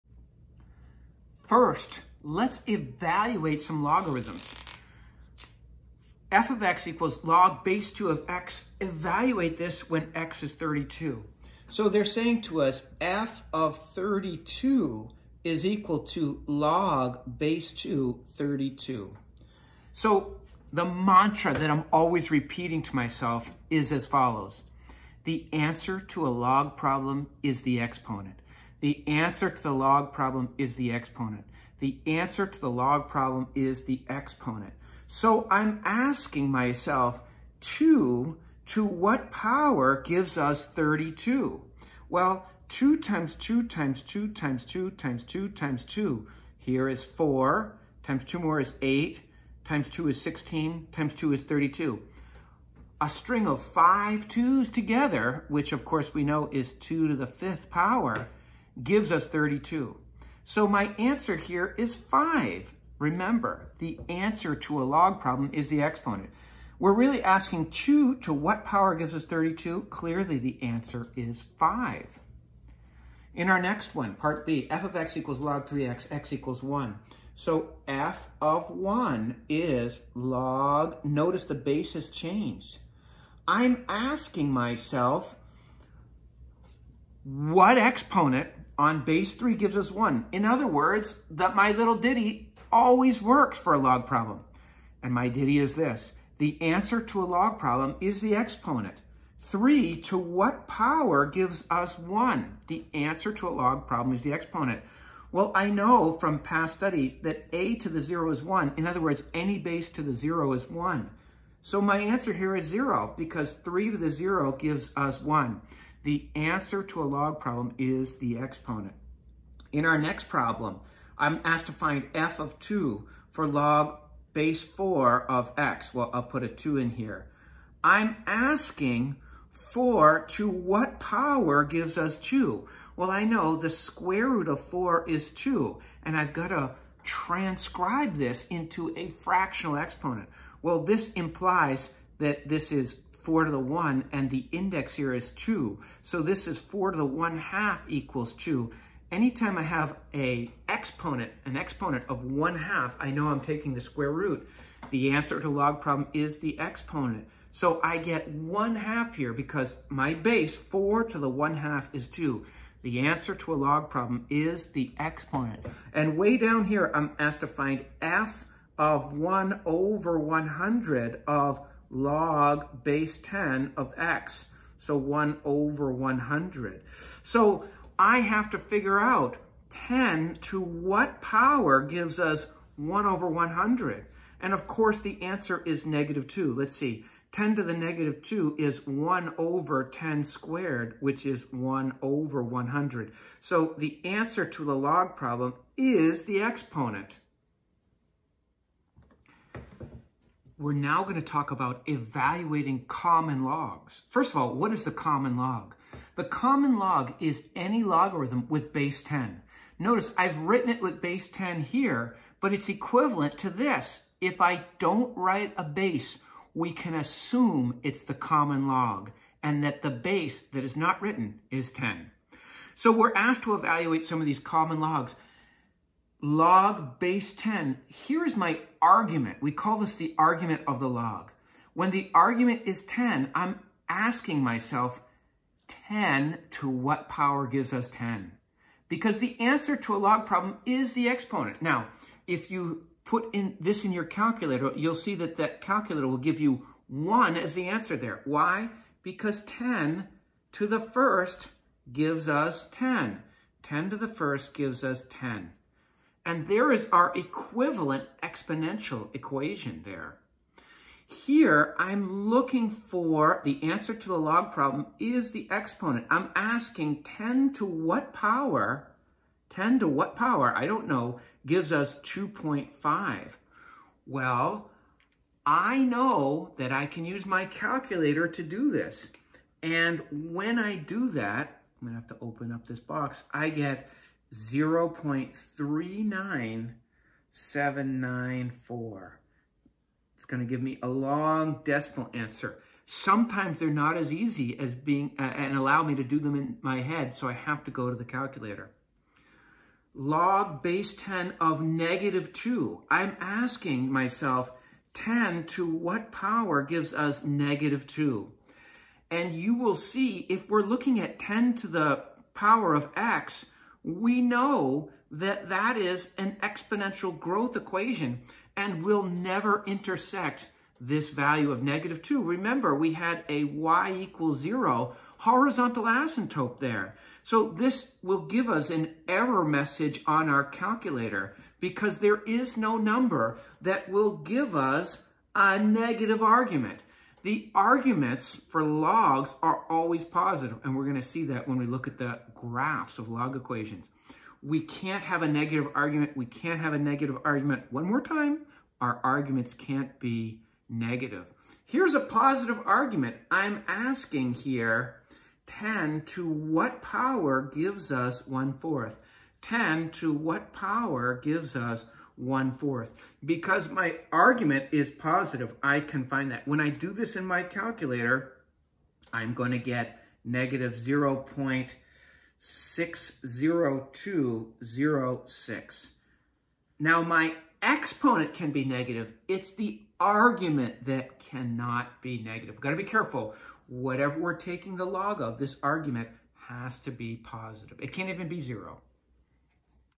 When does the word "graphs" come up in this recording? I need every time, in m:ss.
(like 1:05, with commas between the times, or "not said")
5:42.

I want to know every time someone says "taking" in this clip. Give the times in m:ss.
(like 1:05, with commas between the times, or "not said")
2:33, 6:24.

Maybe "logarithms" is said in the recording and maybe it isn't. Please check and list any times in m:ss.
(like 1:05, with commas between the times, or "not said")
0:03, 3:27.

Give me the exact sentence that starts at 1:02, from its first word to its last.
Remember, the answer to a log problem is the exponent.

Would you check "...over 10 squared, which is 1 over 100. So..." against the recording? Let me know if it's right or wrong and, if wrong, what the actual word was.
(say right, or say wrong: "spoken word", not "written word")
right.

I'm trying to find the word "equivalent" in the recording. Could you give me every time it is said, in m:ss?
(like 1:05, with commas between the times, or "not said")
3:32, 4:17.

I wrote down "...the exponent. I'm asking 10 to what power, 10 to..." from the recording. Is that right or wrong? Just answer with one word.
right.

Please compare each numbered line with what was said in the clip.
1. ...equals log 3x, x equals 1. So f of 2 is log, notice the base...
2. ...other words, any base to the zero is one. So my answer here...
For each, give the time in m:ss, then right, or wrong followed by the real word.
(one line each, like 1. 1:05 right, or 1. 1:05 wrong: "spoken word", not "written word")
1. 1:15 wrong: "1", not "2"
2. 1:48 right.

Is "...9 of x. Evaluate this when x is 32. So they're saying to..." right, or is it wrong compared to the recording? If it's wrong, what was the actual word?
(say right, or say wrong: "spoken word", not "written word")
wrong: "2", not "9".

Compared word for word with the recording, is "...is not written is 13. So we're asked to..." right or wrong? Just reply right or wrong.
wrong.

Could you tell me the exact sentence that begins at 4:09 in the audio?
Because 10 to the first gives us 10.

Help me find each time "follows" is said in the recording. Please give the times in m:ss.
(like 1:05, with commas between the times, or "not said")
0:24.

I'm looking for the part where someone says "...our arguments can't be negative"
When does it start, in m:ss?
5:48.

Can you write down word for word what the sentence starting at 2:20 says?
Well, this implies that this is 4 to the 1, and the index here is 2.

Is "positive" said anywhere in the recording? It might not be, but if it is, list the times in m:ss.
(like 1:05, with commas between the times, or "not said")
5:40, 5:51, 6:04, 6:27.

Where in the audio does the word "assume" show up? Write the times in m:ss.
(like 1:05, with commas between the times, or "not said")
3:36.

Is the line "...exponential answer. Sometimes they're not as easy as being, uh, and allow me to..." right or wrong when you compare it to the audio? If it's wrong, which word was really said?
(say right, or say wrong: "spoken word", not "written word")
wrong: "decimal", not "exponential".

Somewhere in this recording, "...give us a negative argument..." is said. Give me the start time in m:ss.
5:34.